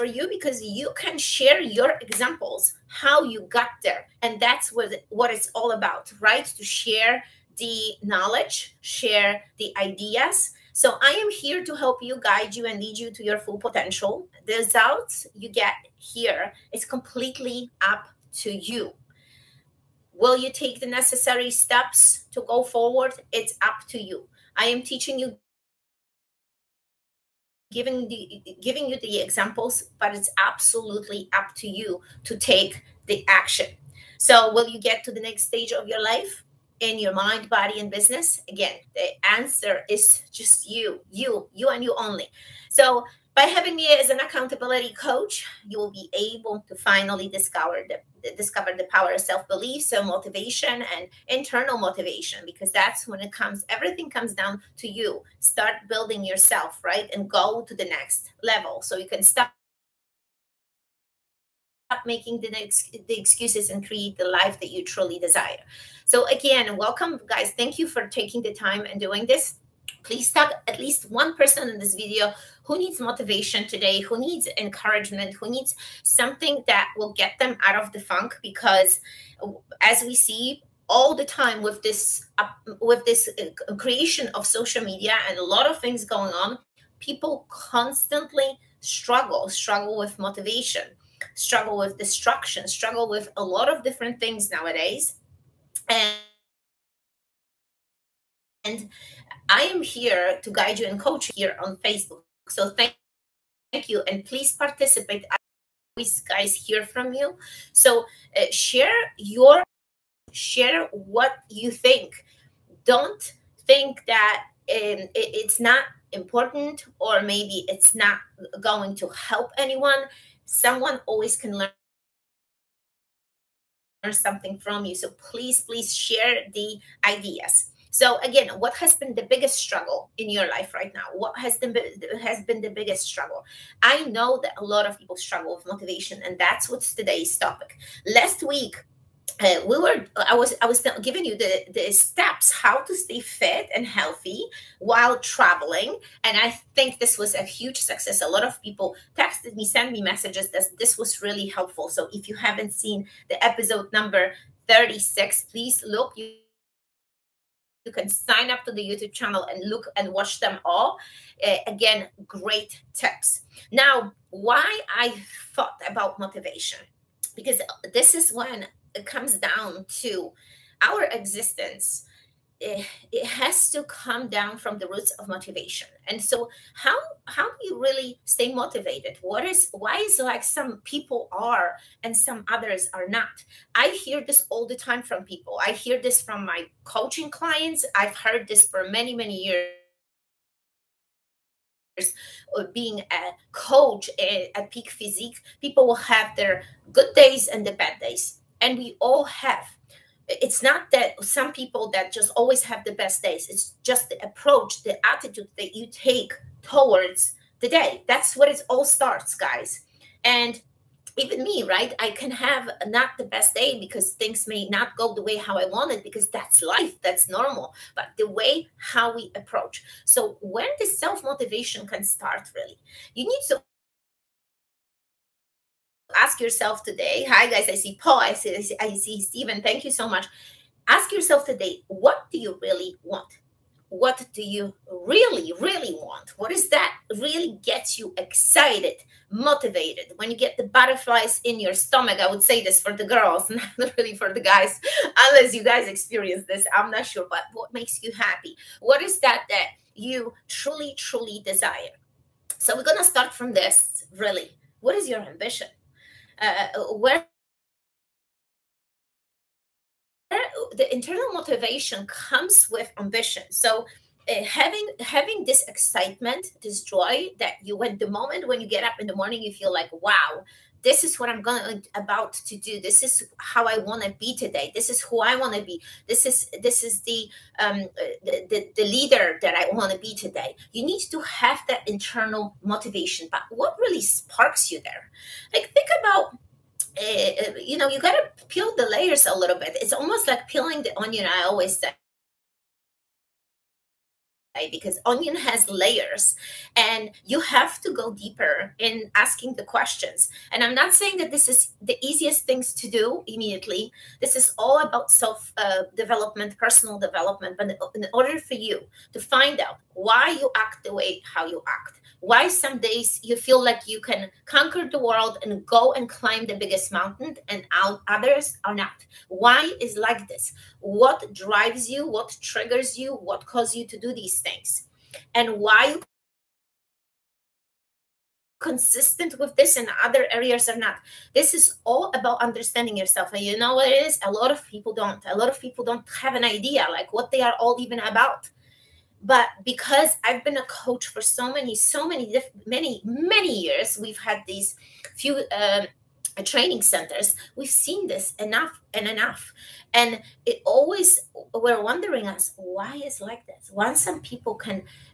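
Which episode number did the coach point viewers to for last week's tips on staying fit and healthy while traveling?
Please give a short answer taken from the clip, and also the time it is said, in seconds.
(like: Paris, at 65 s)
36, at 154 s.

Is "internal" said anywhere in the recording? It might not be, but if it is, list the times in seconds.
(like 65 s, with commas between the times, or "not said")
51 s, 260 s, 281 s.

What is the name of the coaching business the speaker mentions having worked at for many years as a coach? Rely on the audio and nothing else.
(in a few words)
Peak Physique.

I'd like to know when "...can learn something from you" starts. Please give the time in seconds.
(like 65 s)
121 s.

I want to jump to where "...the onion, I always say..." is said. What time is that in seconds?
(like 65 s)
290 s.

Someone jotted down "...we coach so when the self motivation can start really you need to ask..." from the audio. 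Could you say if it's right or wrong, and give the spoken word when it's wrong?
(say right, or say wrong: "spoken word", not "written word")
wrong: "approach", not "coach".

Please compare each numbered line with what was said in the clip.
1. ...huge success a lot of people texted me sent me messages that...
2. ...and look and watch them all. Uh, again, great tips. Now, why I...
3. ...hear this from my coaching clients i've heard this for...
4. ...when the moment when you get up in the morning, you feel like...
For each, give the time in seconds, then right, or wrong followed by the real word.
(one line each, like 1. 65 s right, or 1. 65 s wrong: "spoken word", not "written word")
1. 147 s right
2. 159 s right
3. 185 s right
4. 267 s right.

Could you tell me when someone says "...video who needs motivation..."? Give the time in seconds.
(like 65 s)
71 s.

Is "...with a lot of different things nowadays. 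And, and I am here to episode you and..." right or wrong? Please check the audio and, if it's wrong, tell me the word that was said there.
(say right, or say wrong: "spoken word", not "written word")
wrong: "guide", not "episode".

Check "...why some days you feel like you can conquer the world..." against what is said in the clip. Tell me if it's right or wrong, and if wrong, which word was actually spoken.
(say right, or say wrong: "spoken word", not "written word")
right.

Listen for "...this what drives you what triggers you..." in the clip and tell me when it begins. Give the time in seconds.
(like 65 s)
320 s.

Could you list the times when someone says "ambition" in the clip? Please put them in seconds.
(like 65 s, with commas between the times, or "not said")
255 s, 262 s.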